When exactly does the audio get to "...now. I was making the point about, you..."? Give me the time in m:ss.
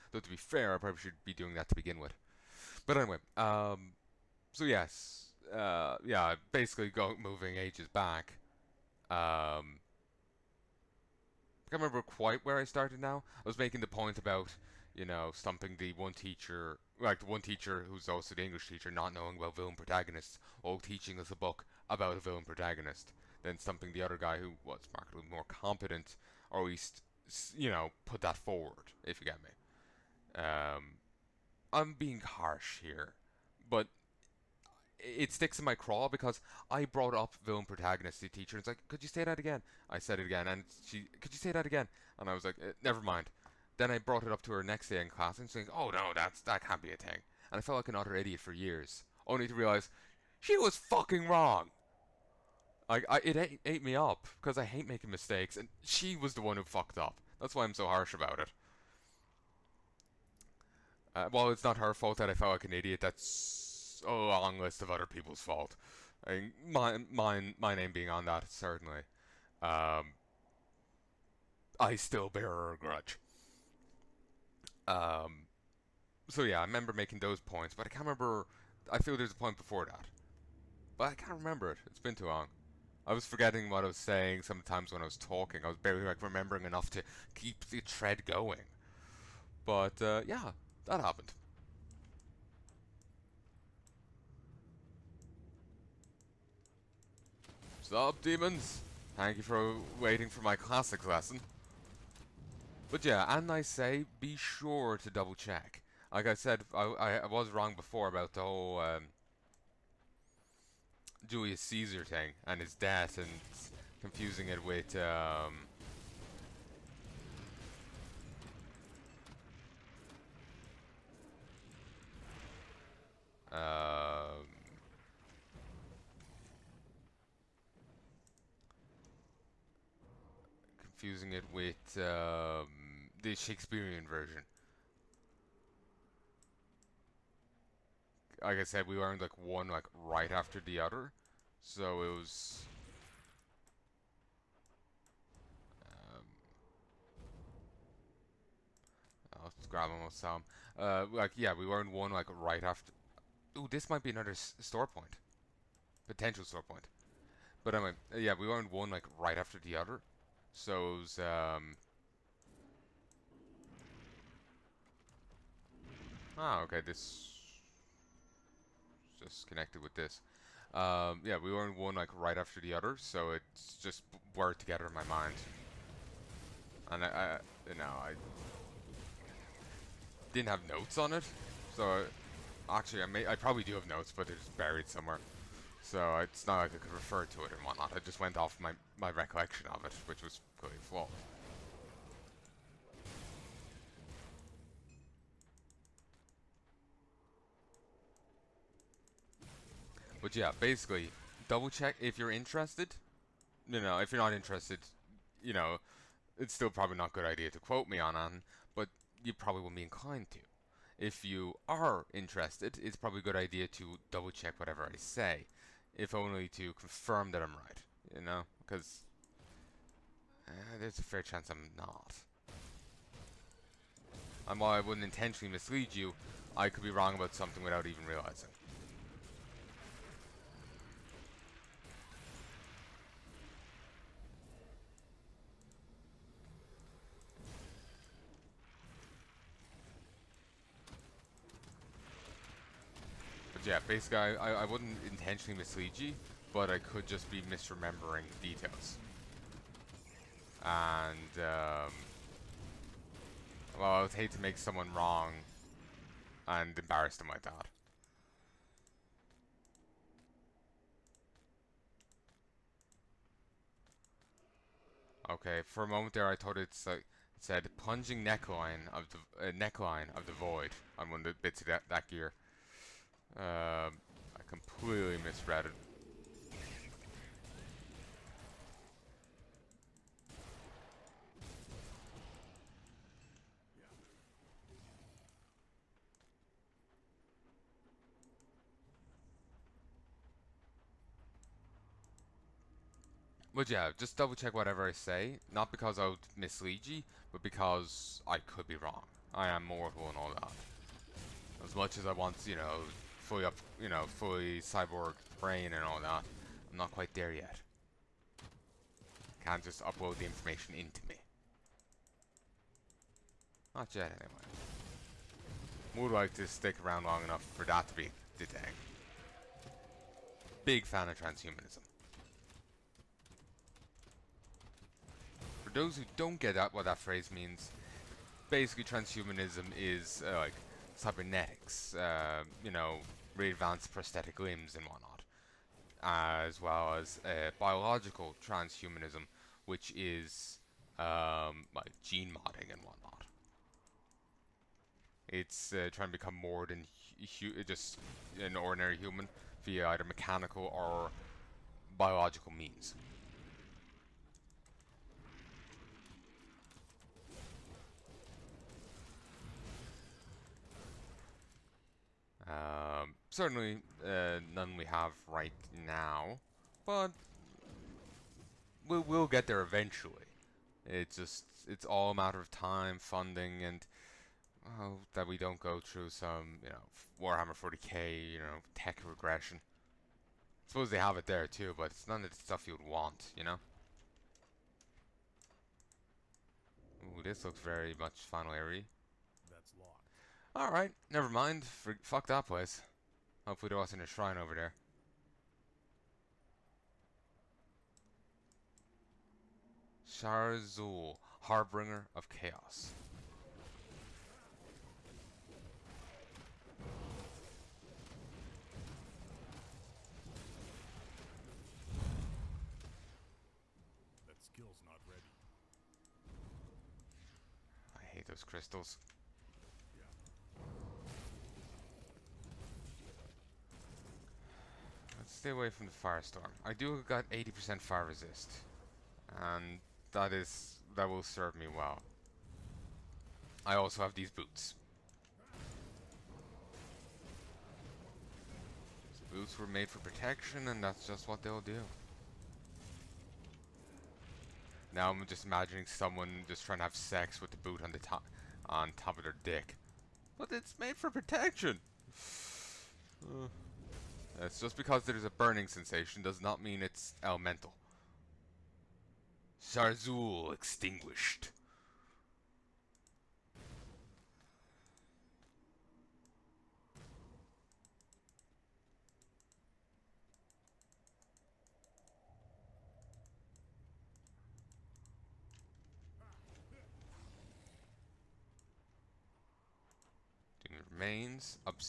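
0:12.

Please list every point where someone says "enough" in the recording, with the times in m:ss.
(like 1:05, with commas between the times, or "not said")
1:26, 5:17.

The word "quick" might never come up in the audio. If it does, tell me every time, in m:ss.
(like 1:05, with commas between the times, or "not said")
not said.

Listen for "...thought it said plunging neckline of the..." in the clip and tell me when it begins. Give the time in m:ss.
4:26.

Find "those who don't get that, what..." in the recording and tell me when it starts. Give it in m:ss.
5:25.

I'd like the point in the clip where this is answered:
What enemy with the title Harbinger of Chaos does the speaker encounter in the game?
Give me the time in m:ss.
6:40.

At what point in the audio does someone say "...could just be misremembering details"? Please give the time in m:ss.
4:06.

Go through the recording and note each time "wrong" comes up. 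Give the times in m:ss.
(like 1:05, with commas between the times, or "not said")
0:51, 1:47, 3:46, 4:14, 4:58.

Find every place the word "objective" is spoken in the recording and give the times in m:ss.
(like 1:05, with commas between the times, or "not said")
not said.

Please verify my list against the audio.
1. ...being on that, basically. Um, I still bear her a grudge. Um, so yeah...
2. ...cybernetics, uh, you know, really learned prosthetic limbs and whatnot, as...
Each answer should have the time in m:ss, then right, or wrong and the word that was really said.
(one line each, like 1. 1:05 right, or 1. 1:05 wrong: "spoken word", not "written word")
1. 1:07 wrong: "certainly", not "basically"
2. 5:30 wrong: "advanced", not "learned".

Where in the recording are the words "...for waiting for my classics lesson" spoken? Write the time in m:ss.
1:39.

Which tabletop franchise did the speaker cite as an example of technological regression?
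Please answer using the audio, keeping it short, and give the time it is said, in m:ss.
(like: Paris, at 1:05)
Warhammer 40k, at 6:17.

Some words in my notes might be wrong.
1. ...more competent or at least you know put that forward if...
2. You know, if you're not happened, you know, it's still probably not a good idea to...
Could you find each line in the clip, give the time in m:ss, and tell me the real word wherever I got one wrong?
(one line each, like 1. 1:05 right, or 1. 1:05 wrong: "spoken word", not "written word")
1. 0:25 right
2. 3:23 wrong: "interested", not "happened".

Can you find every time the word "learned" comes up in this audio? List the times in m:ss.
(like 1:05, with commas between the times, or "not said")
2:18, 2:31, 2:38, 2:51.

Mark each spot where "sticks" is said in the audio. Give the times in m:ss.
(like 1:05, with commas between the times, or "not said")
0:35, 5:16.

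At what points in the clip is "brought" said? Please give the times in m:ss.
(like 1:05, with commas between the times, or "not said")
0:36, 0:43.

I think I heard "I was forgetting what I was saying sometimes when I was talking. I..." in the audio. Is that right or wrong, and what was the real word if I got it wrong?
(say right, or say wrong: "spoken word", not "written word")
right.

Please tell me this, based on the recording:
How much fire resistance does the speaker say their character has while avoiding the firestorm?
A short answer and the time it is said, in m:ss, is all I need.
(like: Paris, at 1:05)
80%, at 7:07.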